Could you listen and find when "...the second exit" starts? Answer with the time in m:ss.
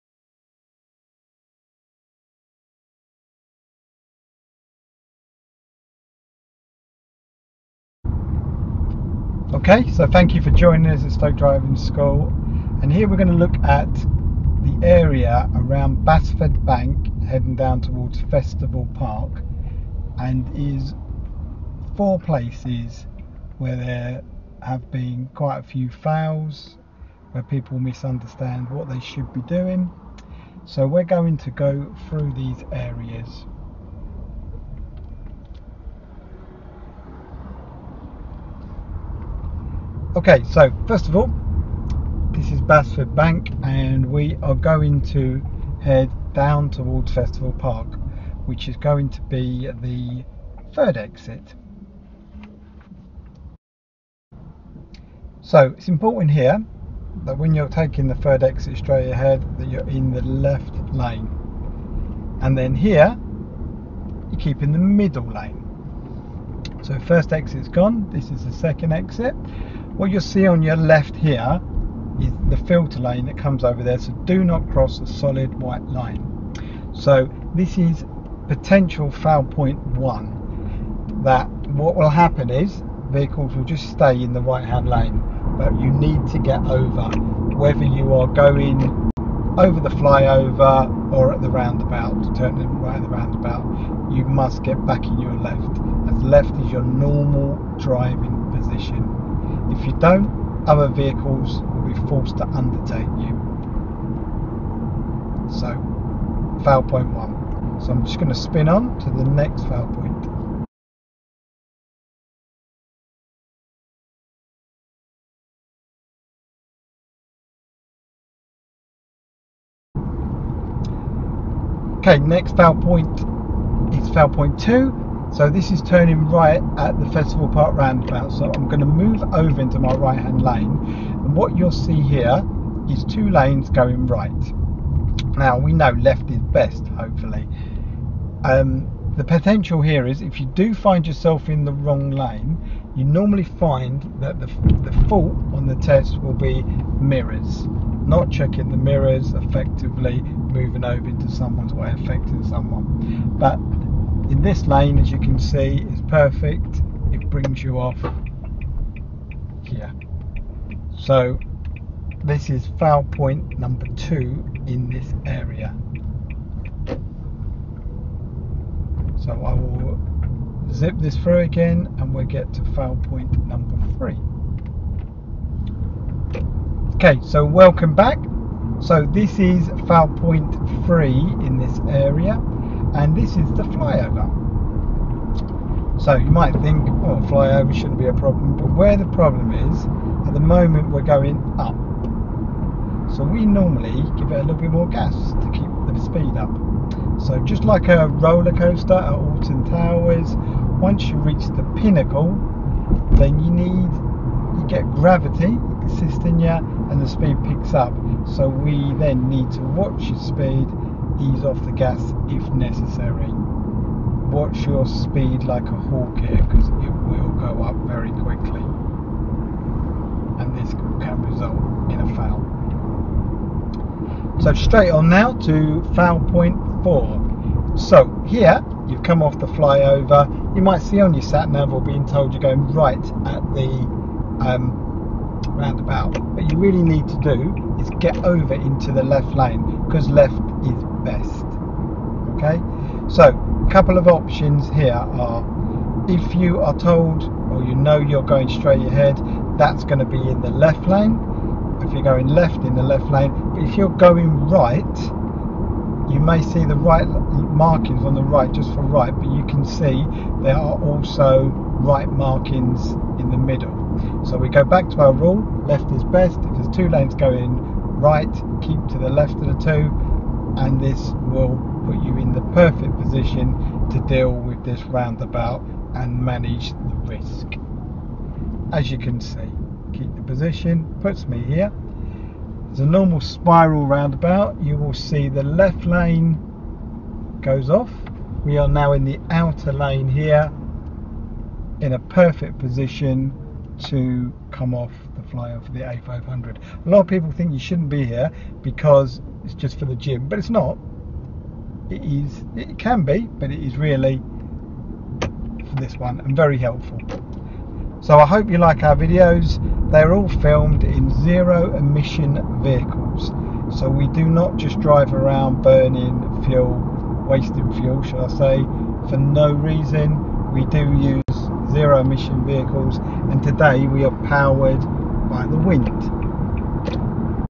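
1:08.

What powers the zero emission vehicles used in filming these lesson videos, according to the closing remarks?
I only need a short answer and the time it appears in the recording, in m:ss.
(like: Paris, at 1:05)
the wind, at 5:25.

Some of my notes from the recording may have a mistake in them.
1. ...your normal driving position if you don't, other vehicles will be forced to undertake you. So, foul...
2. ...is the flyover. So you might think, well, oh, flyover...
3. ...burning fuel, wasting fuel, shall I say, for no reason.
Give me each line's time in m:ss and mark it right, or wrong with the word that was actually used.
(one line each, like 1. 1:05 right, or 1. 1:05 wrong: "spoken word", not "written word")
1. 1:36 right
2. 3:03 right
3. 5:15 right.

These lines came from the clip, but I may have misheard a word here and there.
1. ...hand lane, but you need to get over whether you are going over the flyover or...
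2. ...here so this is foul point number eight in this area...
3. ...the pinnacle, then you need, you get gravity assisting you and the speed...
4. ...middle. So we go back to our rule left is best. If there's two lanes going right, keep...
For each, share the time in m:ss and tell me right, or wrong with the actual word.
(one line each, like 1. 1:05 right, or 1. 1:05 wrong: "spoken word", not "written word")
1. 1:24 right
2. 2:39 wrong: "two", not "eight"
3. 3:21 right
4. 4:23 right.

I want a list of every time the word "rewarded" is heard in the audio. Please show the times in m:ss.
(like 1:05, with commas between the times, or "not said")
not said.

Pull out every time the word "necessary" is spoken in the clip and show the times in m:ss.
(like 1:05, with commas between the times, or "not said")
3:32.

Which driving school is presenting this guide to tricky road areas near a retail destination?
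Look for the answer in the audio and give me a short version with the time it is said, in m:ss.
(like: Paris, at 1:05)
Stoke Driving School, at 0:11.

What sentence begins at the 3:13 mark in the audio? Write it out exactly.
So we normally give it a little bit more gas to keep the speed up.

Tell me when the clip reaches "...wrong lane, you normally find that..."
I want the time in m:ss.
2:21.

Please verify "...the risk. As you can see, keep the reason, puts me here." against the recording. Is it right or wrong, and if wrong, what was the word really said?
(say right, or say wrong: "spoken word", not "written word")
wrong: "position", not "reason".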